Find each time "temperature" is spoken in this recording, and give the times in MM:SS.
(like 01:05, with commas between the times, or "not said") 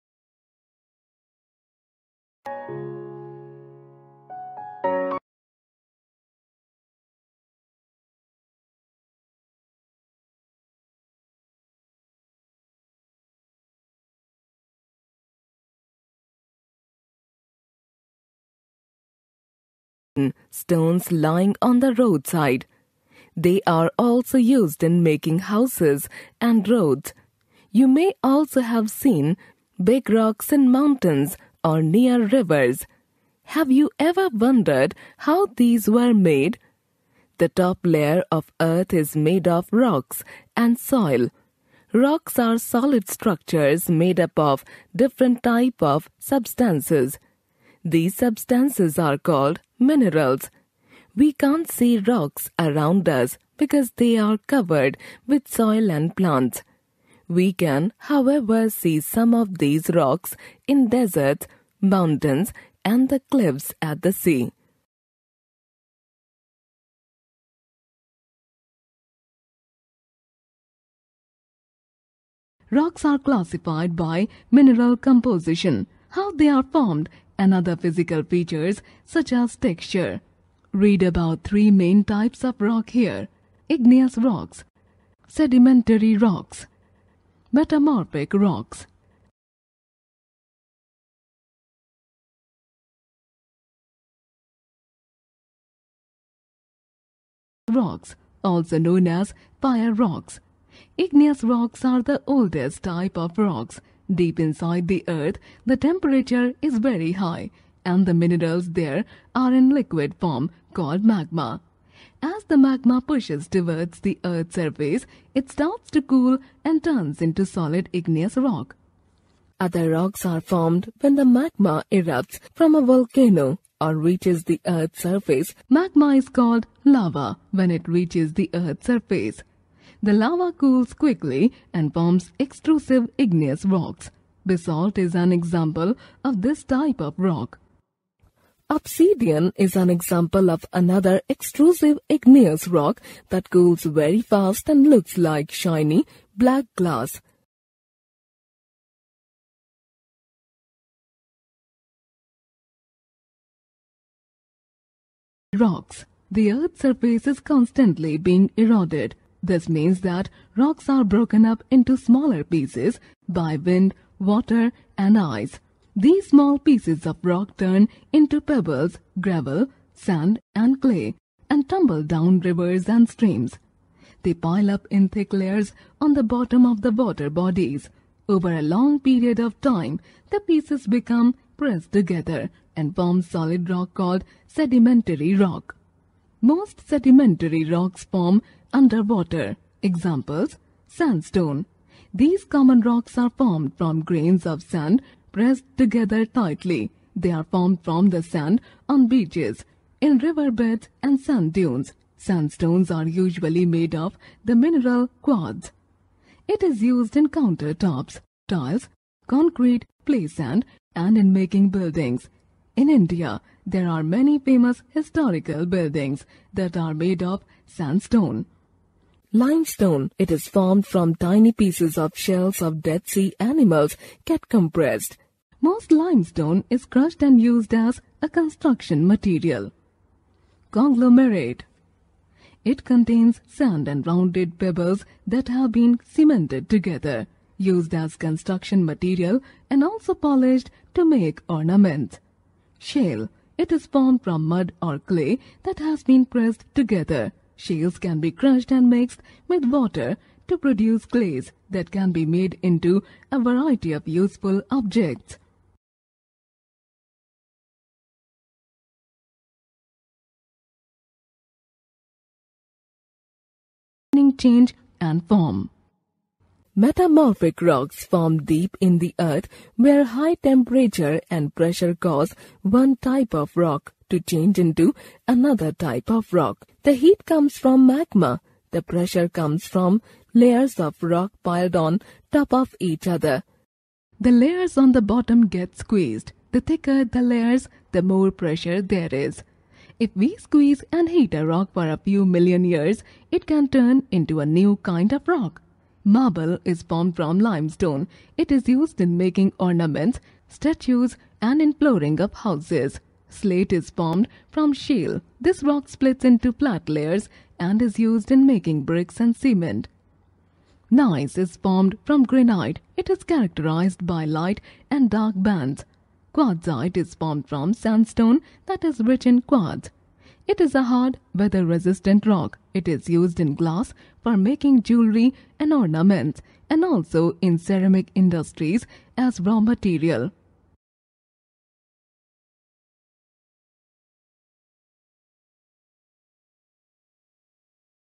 01:45, 04:30.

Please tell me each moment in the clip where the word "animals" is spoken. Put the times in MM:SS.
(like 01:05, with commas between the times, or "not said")
03:43.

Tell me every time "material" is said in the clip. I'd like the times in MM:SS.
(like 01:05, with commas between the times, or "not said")
03:49, 03:58, 05:29.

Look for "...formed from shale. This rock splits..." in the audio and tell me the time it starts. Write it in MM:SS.
05:03.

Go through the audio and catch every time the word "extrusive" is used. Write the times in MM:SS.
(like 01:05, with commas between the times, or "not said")
02:12, 02:21.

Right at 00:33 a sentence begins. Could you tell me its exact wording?
Have you ever wondered how these were made?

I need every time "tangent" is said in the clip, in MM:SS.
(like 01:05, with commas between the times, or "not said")
not said.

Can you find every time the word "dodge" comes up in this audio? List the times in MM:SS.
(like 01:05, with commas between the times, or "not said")
not said.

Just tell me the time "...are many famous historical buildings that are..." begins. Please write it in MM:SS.
03:33.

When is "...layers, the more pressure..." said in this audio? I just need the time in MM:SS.
04:47.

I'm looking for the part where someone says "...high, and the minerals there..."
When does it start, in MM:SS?
01:47.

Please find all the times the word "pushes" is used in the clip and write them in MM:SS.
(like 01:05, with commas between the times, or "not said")
01:53.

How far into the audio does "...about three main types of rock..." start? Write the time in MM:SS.
01:21.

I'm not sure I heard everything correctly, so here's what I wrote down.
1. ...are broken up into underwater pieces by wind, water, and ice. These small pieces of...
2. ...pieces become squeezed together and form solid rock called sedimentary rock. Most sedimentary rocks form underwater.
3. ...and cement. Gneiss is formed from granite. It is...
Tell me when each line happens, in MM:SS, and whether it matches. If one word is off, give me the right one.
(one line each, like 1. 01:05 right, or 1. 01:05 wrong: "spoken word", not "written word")
1. 02:40 wrong: "smaller", not "underwater"
2. 03:00 wrong: "pressed", not "squeezed"
3. 05:09 right.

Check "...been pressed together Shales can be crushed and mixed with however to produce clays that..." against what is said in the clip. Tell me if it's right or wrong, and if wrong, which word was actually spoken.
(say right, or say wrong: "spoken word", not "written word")
wrong: "water", not "however".